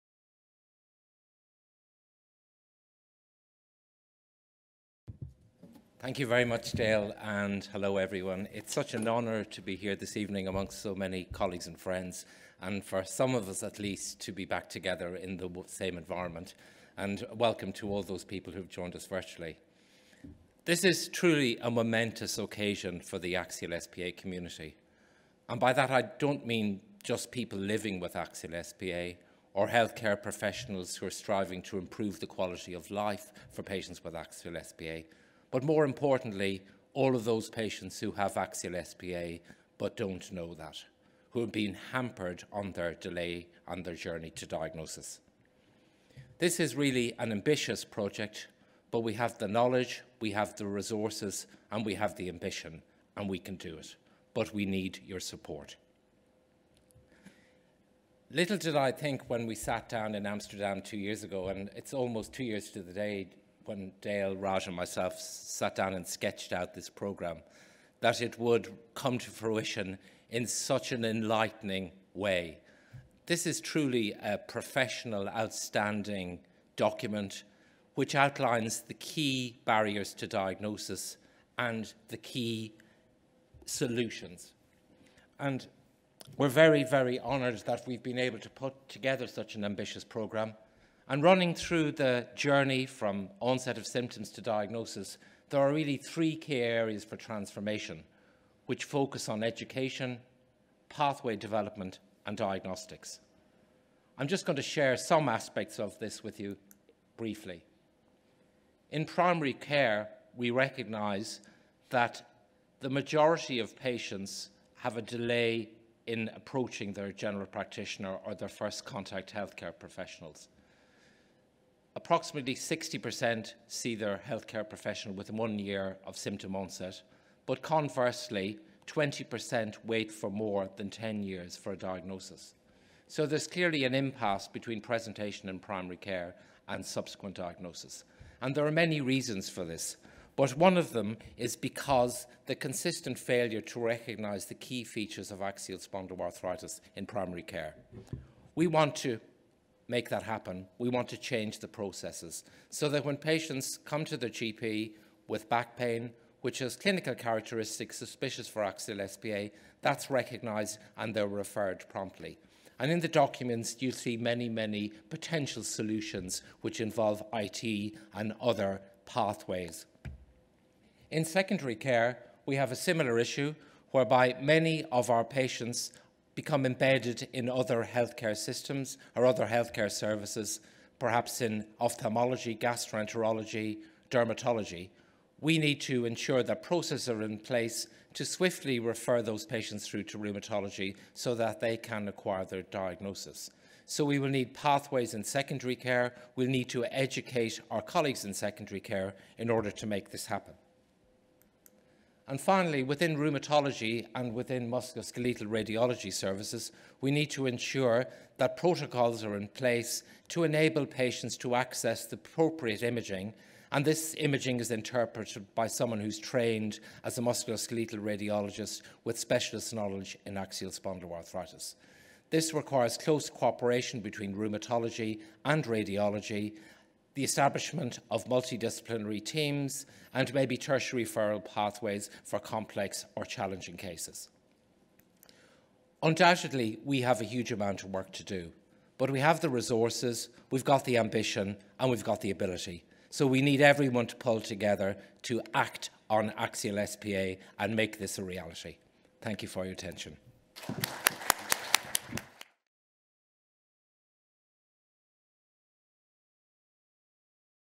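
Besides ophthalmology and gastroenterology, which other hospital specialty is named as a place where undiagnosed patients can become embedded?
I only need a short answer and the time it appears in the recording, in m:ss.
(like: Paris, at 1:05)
Dermatology, at 3:04.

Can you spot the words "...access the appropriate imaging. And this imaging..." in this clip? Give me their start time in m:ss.
3:31.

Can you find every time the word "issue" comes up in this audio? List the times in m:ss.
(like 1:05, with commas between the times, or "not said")
2:53.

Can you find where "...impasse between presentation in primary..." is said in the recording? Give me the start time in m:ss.
2:13.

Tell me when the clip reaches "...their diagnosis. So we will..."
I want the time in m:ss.
3:12.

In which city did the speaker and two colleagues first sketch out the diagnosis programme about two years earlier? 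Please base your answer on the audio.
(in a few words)
Amsterdam.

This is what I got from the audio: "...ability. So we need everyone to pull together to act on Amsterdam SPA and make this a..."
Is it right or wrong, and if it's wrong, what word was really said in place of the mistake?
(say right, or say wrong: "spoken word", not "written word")
wrong: "Axial", not "Amsterdam".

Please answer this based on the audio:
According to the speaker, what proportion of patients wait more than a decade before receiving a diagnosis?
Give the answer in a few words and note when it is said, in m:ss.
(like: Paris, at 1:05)
20%, at 2:08.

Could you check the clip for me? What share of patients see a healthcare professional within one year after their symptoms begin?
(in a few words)
60%.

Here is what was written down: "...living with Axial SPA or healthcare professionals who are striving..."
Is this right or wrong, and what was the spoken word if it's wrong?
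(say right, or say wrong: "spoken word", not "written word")
right.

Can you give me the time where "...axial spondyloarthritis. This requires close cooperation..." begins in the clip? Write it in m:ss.
3:40.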